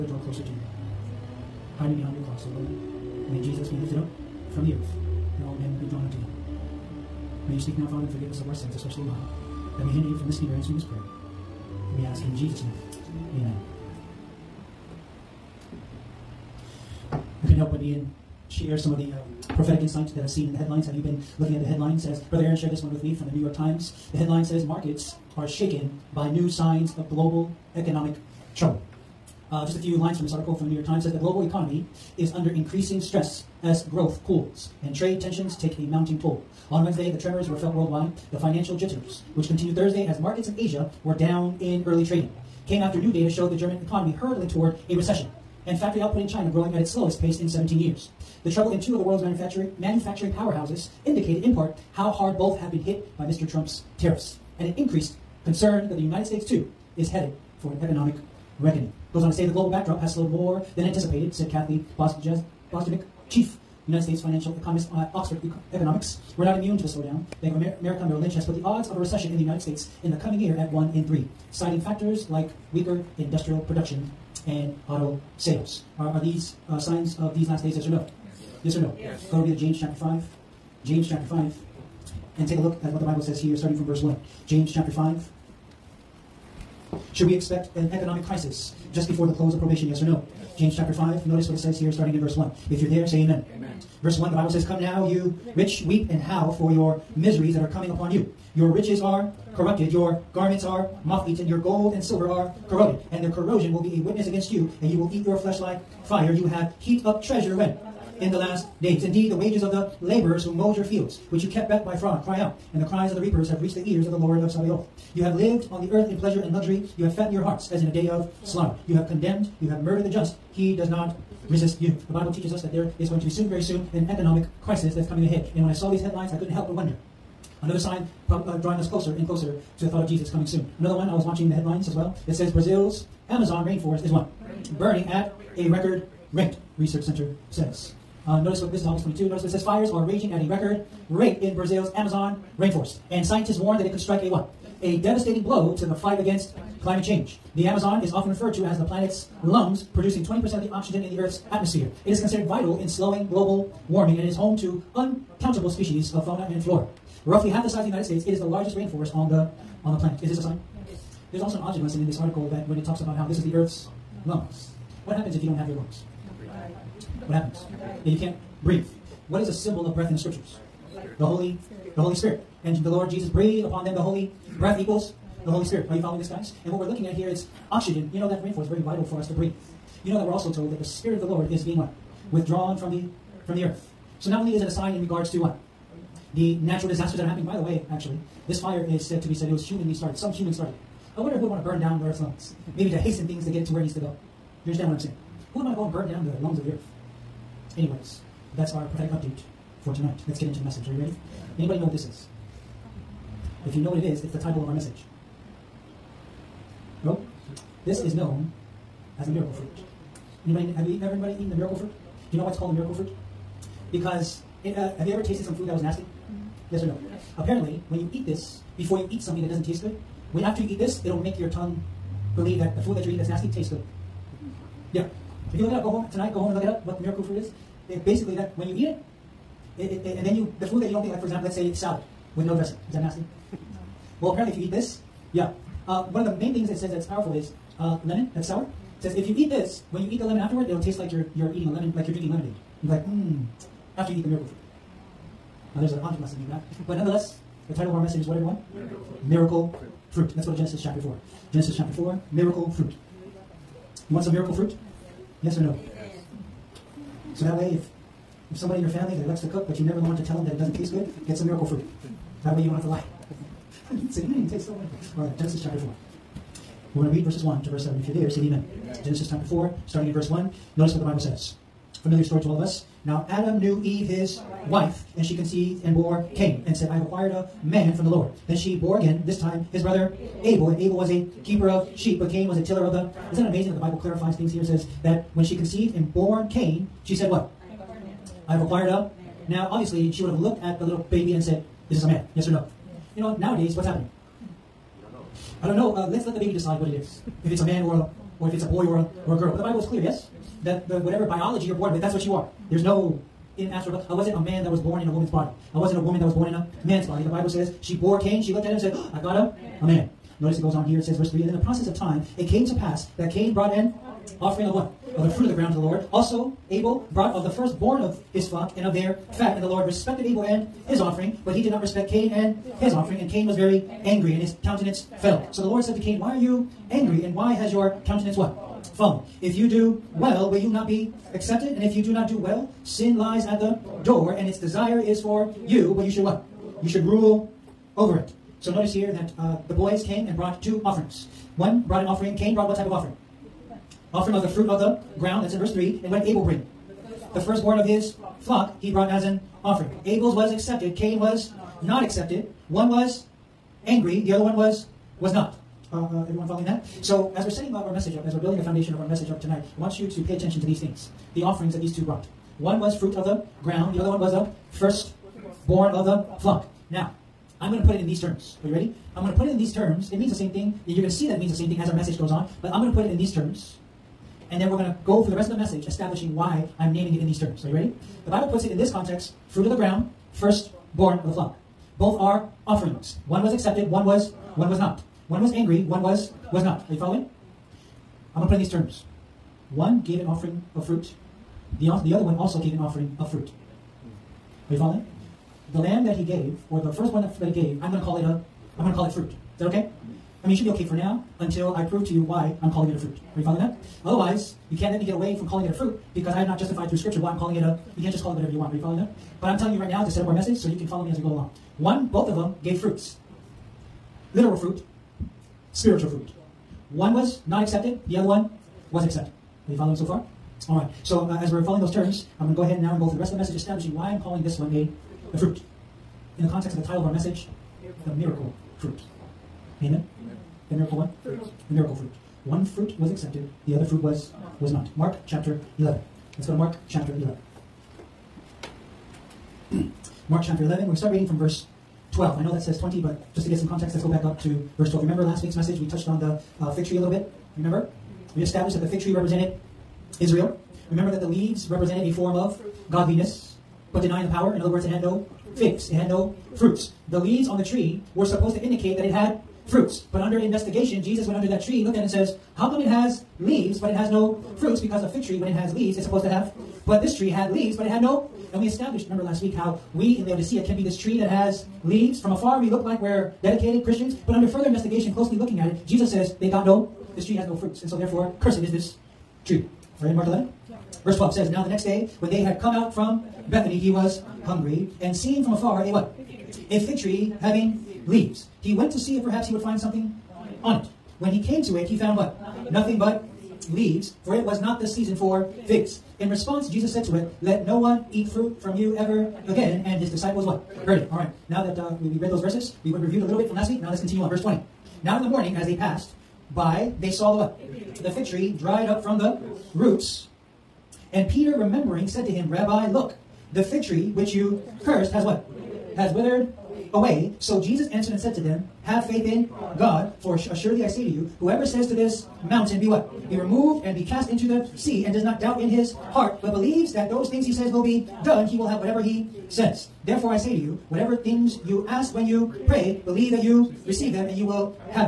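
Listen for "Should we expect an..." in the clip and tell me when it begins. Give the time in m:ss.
1:27.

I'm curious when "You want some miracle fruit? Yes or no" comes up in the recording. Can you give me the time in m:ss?
4:14.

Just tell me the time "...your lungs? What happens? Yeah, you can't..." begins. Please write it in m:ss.
2:45.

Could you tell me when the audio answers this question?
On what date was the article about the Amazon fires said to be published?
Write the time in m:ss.
2:18.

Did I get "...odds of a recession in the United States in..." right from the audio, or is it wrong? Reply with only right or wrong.
right.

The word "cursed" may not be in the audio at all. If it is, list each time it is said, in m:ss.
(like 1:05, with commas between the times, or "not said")
7:58, 8:34.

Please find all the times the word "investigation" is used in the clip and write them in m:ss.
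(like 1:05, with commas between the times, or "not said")
7:40, 7:54.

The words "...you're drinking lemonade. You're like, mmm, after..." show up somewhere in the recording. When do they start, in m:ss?
4:02.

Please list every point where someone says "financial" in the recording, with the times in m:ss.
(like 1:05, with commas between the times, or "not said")
0:38, 1:04.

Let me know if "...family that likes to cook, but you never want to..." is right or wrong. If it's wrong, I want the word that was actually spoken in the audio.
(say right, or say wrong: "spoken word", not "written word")
right.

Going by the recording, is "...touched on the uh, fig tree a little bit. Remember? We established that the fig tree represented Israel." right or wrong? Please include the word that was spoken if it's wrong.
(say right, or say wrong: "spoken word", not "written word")
right.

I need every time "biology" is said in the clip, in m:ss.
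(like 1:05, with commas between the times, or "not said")
5:01.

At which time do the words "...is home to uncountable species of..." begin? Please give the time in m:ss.
2:34.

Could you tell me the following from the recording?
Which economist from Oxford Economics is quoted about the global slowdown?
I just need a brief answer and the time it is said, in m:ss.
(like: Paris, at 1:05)
Kathy Bostjancic, at 1:01.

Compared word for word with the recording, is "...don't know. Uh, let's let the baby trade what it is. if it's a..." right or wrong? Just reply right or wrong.
wrong.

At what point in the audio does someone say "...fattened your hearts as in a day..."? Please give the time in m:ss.
1:57.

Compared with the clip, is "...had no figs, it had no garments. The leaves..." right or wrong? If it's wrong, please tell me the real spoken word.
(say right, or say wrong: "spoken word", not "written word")
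wrong: "fruits", not "garments".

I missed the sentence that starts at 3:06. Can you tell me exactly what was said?
The natural disasters that are happening, by the way, actually, this fire is said to be said it was humanly started.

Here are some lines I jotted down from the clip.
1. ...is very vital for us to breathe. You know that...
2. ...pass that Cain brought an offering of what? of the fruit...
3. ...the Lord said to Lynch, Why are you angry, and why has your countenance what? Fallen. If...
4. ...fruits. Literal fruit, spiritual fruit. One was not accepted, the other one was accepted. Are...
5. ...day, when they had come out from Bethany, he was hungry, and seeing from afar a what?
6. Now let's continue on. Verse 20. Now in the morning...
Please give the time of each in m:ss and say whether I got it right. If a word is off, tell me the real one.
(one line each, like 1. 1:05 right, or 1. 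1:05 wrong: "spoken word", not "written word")
1. 2:58 right
2. 5:12 right
3. 5:25 wrong: "Cain", not "Lynch"
4. 6:52 right
5. 8:01 right
6. 8:23 right.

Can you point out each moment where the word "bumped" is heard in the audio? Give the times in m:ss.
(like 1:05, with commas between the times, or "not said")
not said.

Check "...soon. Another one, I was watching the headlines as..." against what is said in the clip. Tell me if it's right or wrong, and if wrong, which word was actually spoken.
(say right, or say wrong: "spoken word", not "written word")
right.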